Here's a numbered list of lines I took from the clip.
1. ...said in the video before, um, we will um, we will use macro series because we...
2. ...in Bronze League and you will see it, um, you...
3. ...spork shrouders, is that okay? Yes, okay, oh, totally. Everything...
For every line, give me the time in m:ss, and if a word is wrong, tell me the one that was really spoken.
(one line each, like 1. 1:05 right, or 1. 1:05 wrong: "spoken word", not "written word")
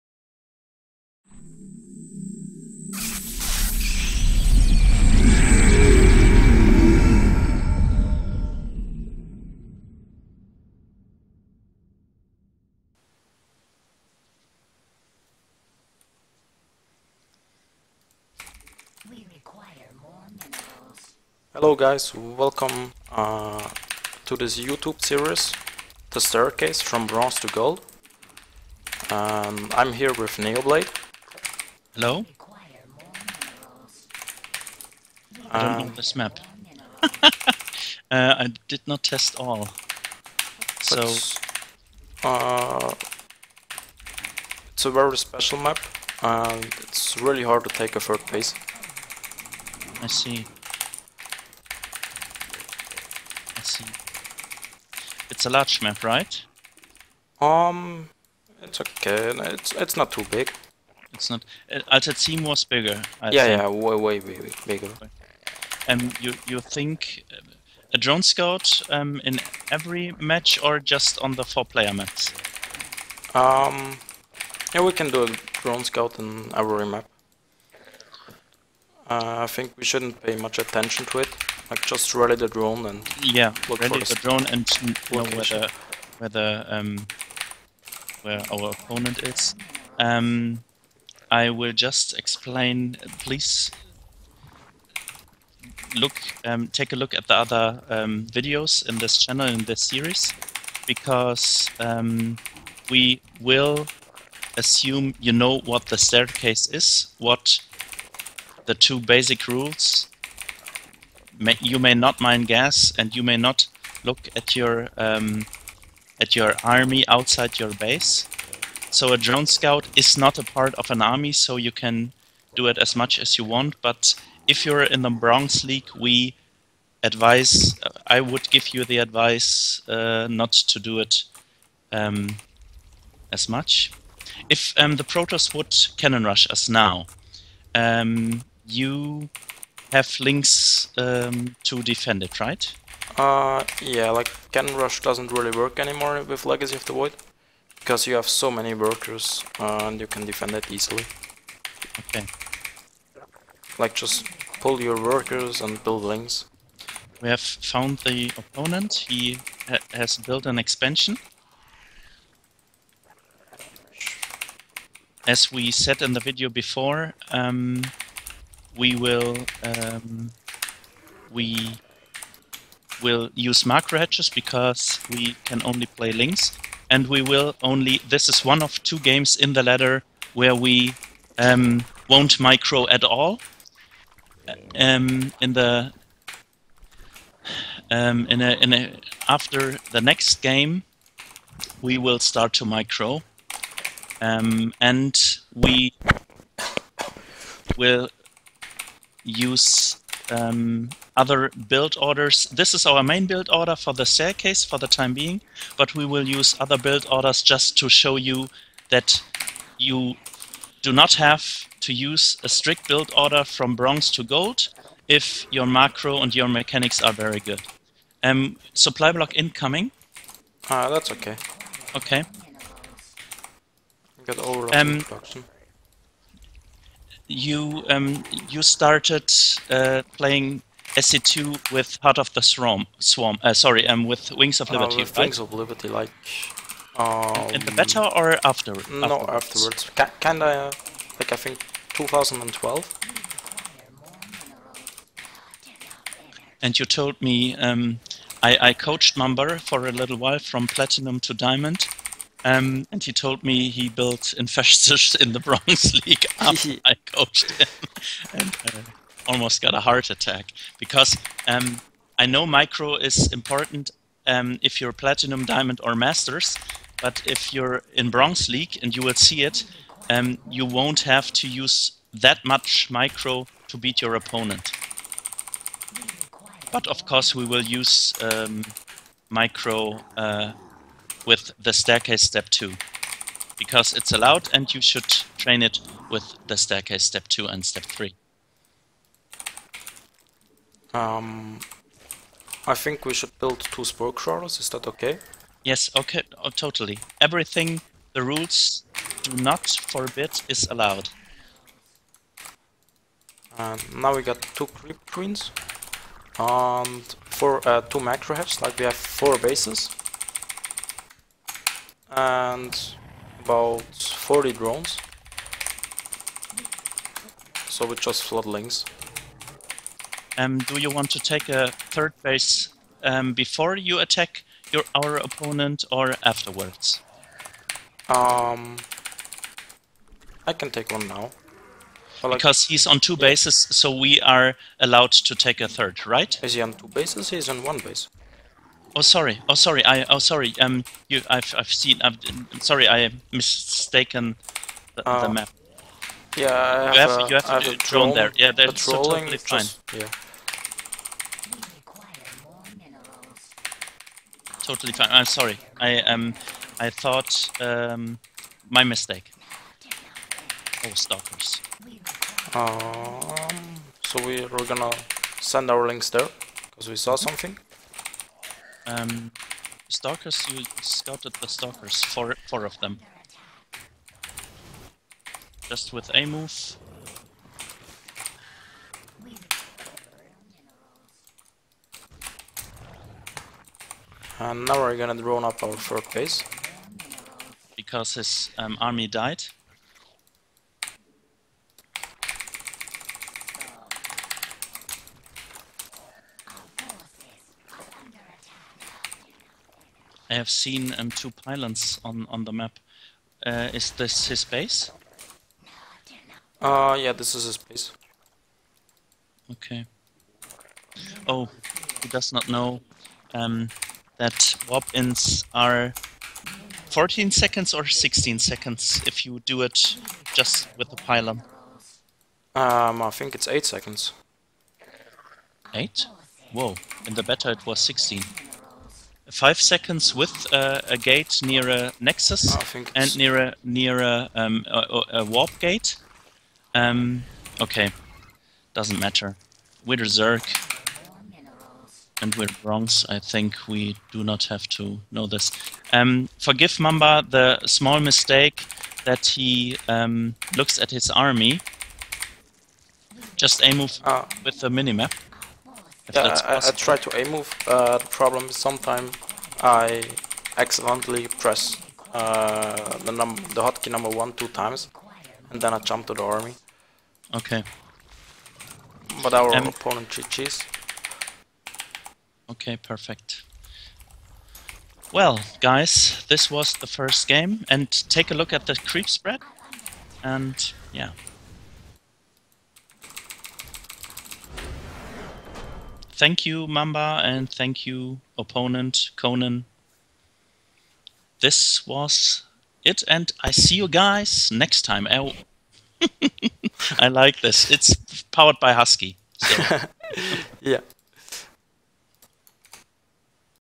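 1. 2:45 wrong: "hatches", not "series"
2. 4:27 right
3. 4:53 right.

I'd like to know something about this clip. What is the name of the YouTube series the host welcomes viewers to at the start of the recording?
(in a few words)
The Staircase from Bronze to Gold.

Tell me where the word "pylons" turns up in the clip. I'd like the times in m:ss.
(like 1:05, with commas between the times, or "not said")
6:41, 7:00.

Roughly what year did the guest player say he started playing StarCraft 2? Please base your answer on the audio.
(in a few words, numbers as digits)
2012.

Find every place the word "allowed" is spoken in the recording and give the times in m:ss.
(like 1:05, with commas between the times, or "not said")
4:44, 5:00, 5:34.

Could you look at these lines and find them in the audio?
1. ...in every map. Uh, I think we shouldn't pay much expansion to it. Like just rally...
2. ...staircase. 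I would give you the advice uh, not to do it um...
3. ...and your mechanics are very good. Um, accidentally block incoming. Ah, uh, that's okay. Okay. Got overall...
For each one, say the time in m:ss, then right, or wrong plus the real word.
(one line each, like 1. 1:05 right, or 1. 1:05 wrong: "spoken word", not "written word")
1. 1:16 wrong: "attention", not "expansion"
2. 2:07 wrong: "advise", not "staircase"
3. 3:36 wrong: "supply", not "accidentally".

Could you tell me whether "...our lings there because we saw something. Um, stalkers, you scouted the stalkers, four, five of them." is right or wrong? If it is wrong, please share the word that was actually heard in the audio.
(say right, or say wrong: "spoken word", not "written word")
wrong: "four", not "five".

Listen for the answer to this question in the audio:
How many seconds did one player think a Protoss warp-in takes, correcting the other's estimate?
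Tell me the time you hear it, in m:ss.
7:03.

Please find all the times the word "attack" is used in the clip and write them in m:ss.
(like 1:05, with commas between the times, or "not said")
4:20, 5:23.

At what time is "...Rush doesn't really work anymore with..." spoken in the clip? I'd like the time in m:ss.
2:24.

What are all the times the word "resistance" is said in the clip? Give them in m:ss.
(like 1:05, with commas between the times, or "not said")
not said.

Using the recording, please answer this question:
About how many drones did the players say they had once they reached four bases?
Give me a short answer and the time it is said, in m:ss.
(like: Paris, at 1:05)
40, at 5:13.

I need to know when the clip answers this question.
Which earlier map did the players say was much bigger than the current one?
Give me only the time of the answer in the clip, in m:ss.
1:01.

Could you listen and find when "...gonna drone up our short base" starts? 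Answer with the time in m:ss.
6:24.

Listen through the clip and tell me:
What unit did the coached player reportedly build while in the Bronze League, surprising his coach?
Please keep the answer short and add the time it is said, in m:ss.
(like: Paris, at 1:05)
Infestors, at 4:14.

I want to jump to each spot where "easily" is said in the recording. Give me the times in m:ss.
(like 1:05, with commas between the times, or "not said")
2:30.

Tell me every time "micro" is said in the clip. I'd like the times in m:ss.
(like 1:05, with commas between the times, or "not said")
3:02, 3:12, 4:22, 4:32, 4:39.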